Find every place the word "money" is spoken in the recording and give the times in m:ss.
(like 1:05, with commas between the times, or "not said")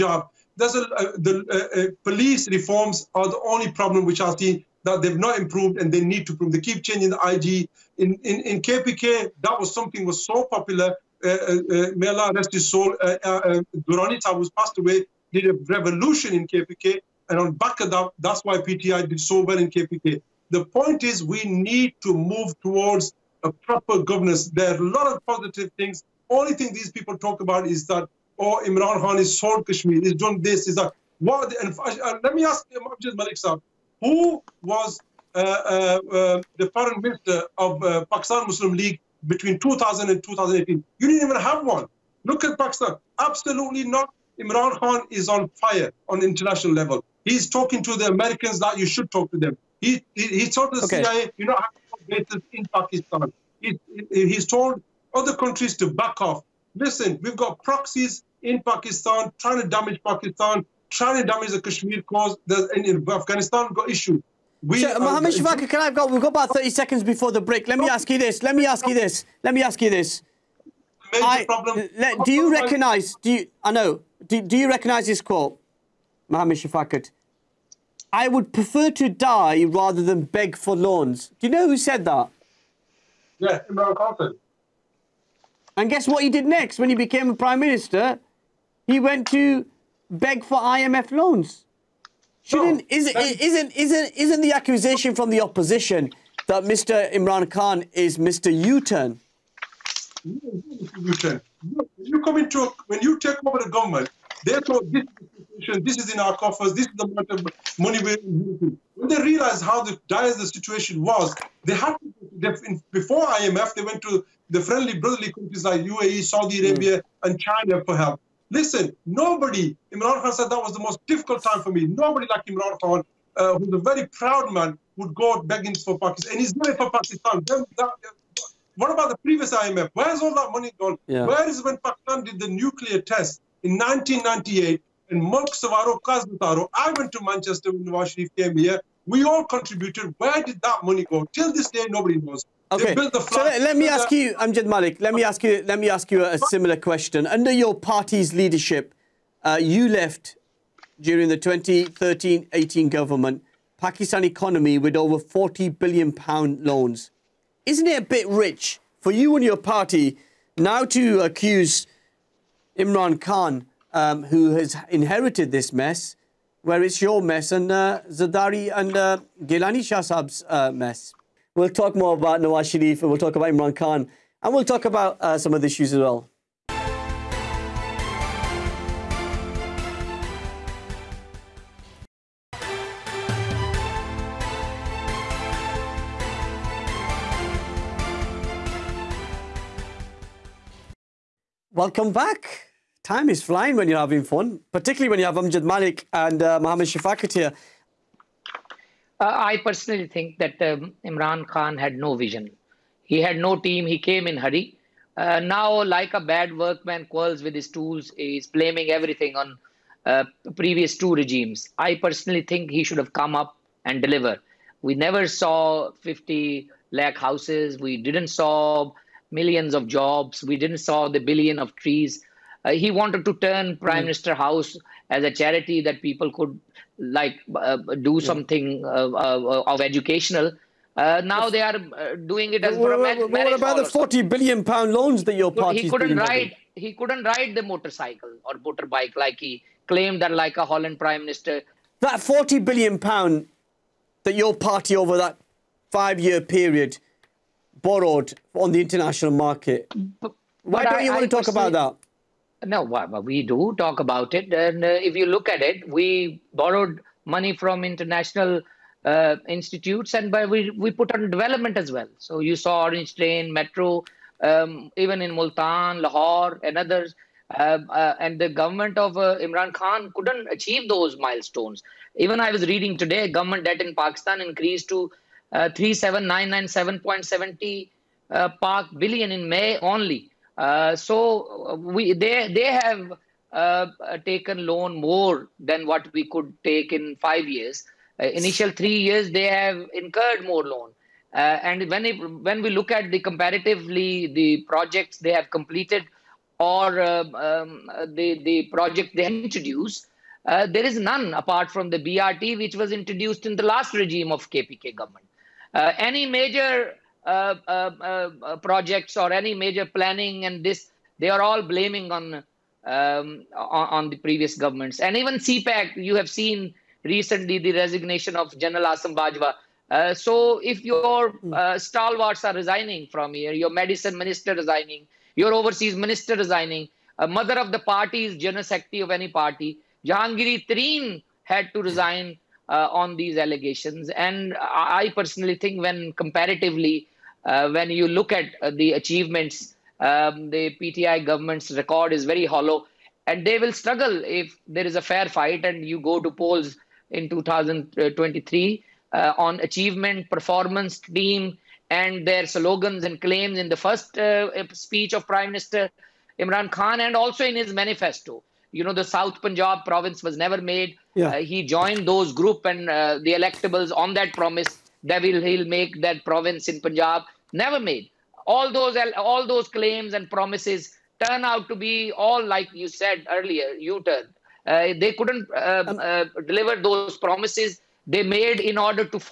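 1:47, 2:10, 2:20, 4:17.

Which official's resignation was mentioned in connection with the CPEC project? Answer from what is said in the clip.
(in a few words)
General Asim Bajwa.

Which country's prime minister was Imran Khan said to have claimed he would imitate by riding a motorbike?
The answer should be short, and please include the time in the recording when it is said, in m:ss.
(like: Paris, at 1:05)
Holland, at 4:00.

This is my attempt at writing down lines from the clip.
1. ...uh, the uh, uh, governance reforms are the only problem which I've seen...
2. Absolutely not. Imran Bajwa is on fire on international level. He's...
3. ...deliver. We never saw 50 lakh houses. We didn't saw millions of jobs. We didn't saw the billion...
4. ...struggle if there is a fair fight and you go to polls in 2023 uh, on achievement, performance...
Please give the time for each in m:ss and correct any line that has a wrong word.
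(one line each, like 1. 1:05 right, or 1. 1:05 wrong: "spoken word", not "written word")
1. 0:00 wrong: "police", not "governance"
2. 0:43 wrong: "Khan", not "Bajwa"
3. 3:34 right
4. 5:43 right.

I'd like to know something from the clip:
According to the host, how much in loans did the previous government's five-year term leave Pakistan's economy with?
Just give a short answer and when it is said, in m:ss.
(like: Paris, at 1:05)
over 40 billion pounds, at 2:34.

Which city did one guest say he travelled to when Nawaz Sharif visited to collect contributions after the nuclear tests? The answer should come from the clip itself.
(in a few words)
Manchester.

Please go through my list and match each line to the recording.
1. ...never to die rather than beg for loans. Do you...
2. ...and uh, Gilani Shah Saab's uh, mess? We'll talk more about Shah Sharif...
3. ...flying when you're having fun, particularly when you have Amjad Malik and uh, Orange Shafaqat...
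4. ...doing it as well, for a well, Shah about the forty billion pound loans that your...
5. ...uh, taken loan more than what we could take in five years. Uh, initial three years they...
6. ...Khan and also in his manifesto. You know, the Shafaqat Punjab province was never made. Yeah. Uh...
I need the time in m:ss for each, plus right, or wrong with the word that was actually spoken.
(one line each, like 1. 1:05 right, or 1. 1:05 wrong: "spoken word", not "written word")
1. 1:18 wrong: "prefer", not "never"
2. 2:48 wrong: "Nawaz", not "Shah"
3. 3:13 wrong: "Mohammed", not "Orange"
4. 3:52 wrong: "What", not "Shah"
5. 4:43 right
6. 5:56 wrong: "South", not "Shafaqat".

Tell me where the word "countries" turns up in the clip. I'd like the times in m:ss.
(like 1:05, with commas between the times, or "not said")
0:55, 1:55.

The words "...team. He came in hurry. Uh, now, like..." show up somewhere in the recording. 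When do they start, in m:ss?
3:23.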